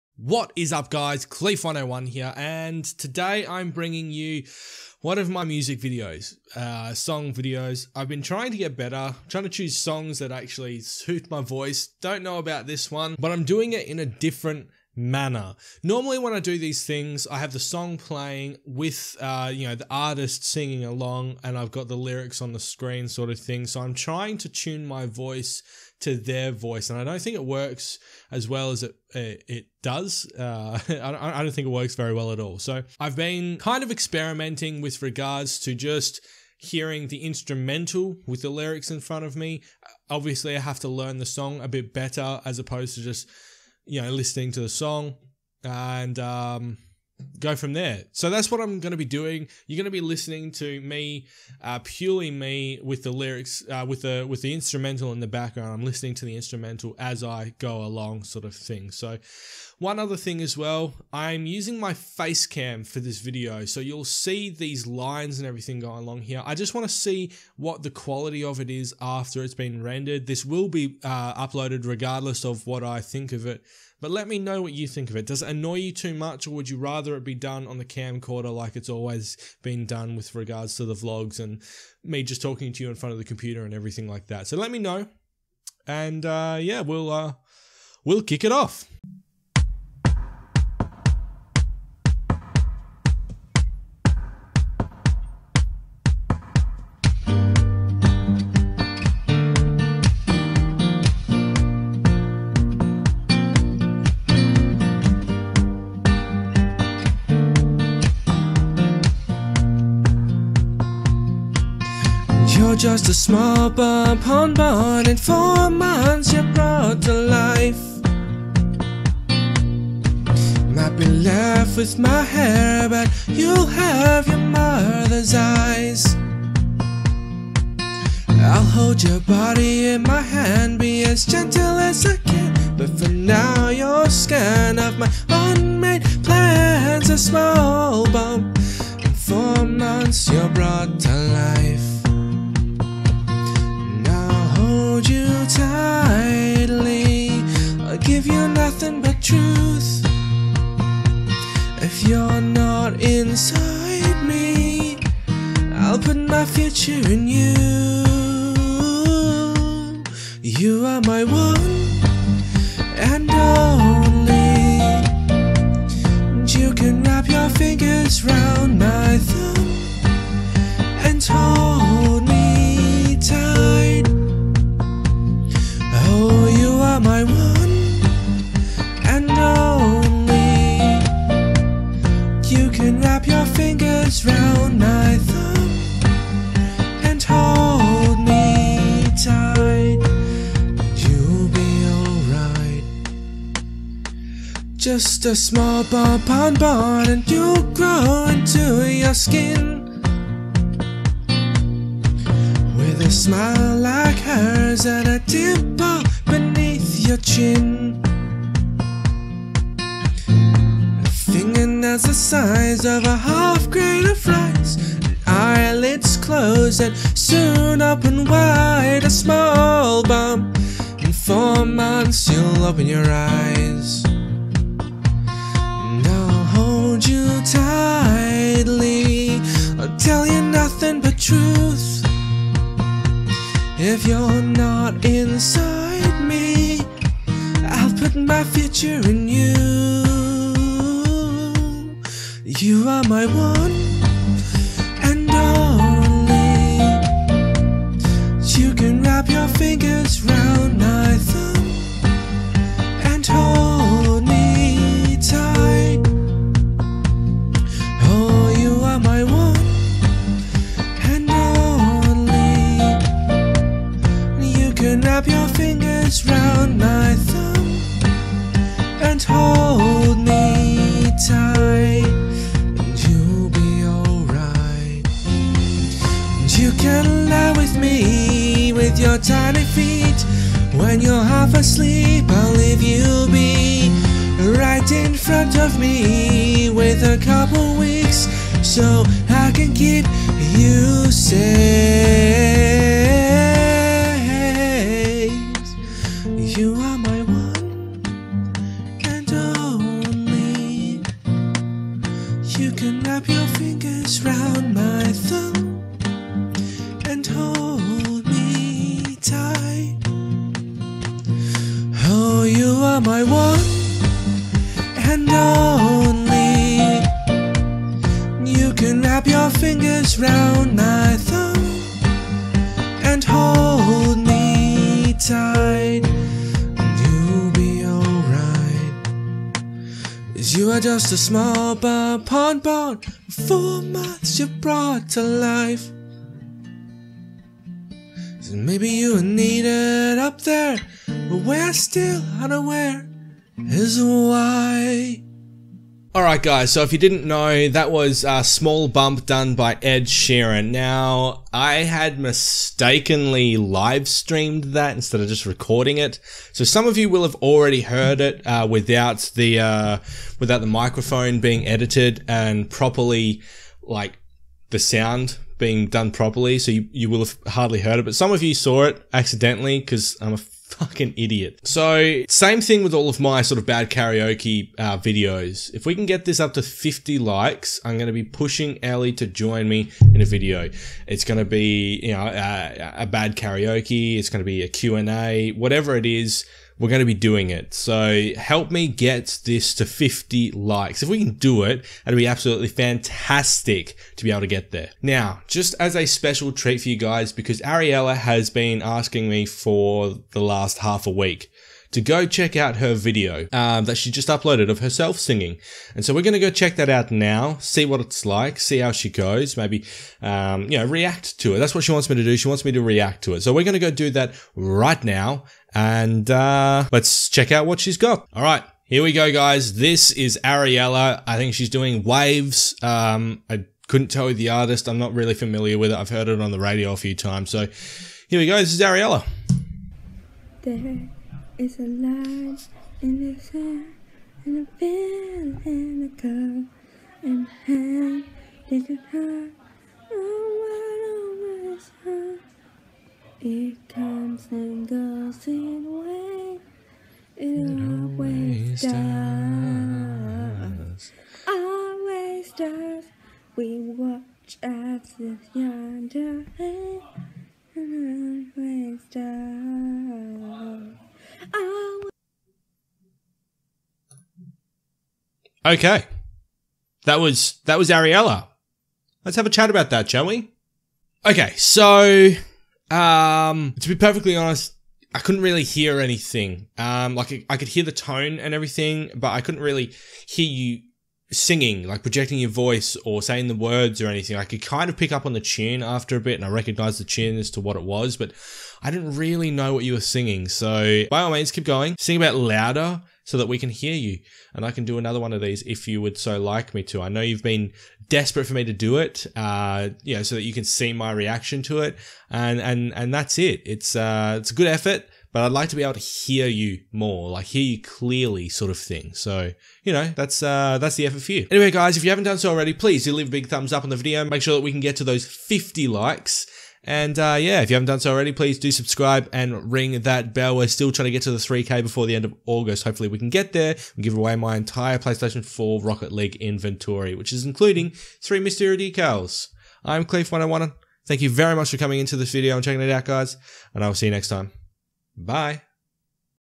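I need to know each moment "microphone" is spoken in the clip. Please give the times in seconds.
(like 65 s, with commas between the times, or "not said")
360 s.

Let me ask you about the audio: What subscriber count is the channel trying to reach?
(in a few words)
3K.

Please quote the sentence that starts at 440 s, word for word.
Oh, what always it comes and goes in waves.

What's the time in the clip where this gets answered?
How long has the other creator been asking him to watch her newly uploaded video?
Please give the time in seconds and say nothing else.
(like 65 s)
400 s.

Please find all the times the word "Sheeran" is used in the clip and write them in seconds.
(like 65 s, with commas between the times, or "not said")
350 s.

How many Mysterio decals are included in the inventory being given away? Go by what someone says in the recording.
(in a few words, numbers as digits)
3.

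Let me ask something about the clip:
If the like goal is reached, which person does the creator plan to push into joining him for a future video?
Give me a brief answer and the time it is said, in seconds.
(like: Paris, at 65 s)
Ellie, at 378 s.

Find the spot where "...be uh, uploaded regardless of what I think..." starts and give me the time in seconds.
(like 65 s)
70 s.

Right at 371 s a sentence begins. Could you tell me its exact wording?
So, same thing with all of my sort of bad karaoke uh, videos.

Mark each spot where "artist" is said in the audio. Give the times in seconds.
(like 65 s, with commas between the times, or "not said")
19 s, 424 s.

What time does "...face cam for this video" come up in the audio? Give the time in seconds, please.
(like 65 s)
61 s.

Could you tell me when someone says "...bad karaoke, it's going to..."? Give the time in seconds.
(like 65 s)
383 s.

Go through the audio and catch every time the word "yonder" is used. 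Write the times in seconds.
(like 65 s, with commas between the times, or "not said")
455 s.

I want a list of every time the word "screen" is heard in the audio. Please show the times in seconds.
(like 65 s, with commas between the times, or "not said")
22 s.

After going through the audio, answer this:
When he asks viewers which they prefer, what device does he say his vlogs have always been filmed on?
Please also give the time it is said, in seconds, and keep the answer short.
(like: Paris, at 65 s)
camcorder, at 77 s.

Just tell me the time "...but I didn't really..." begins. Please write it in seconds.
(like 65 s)
488 s.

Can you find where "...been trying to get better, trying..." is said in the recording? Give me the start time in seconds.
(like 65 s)
8 s.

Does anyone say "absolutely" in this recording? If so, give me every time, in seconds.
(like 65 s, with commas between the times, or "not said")
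392 s.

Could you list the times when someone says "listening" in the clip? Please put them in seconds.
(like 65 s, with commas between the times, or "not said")
44 s, 50 s, 55 s.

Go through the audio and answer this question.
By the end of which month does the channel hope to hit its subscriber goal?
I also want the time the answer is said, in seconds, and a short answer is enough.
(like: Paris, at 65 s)
August, at 522 s.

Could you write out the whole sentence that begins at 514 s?
Make sure that we can get to those 50 likes.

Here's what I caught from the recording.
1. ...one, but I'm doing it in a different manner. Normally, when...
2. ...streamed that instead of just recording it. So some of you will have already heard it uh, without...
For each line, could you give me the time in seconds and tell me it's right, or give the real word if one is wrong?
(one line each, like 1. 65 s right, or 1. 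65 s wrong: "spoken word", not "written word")
1. 12 s right
2. 354 s right.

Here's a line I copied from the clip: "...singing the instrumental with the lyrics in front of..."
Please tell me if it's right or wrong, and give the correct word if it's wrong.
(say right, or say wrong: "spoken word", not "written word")
wrong: "hearing", not "singing".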